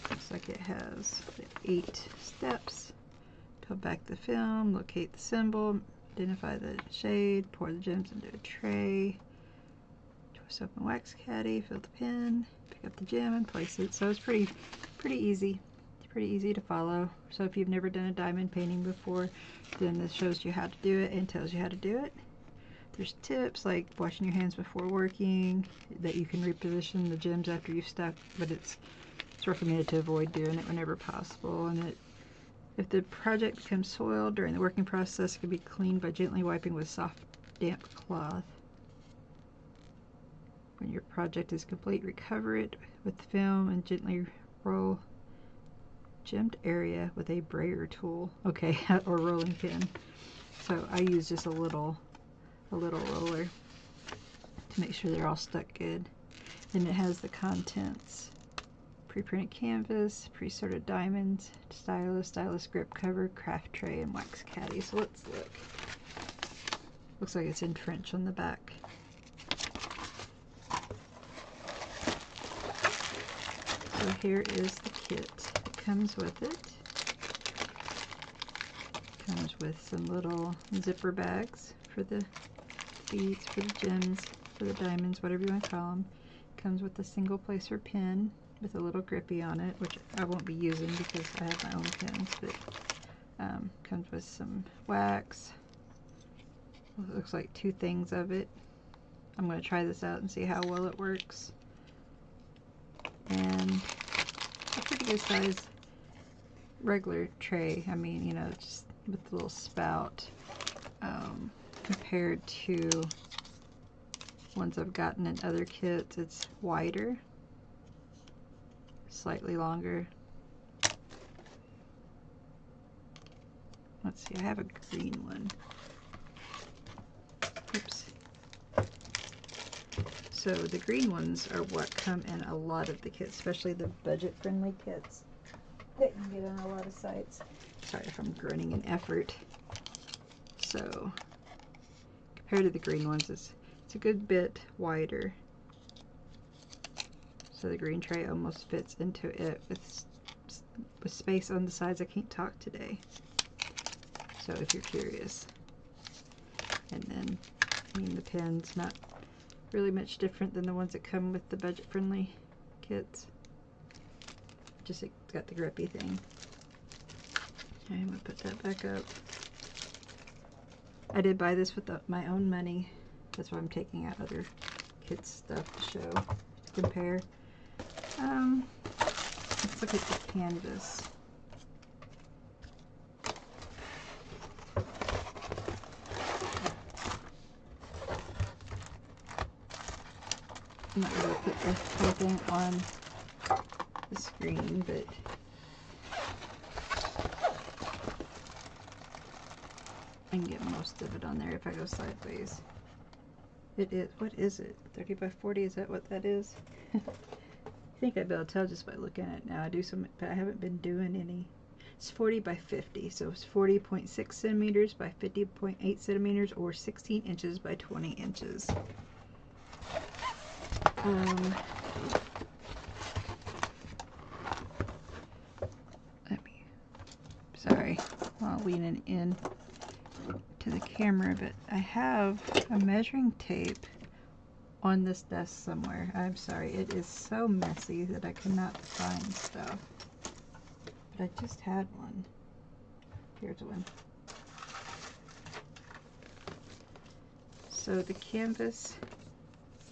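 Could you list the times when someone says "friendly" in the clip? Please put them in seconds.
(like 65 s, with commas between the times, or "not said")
134 s, 161 s.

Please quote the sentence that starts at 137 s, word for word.
Sorry if I'm grinning in effort.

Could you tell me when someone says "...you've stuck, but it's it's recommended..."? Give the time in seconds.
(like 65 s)
27 s.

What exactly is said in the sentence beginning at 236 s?
I'm sorry, it is so messy that I cannot find stuff.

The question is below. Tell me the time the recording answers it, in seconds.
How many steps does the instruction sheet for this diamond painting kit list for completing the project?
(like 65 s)
1 s.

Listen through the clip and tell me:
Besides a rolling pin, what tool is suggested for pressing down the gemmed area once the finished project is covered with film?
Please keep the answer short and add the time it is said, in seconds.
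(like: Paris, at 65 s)
brayer tool, at 47 s.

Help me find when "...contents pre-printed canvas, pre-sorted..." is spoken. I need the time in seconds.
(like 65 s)
57 s.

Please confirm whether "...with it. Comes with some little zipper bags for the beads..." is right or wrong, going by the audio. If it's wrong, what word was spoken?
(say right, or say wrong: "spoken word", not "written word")
right.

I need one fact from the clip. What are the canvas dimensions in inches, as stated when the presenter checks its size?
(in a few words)
16 by 20 inches.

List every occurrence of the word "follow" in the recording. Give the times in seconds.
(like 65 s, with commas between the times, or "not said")
16 s.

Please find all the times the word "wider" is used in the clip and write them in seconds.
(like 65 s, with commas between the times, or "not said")
116 s, 144 s.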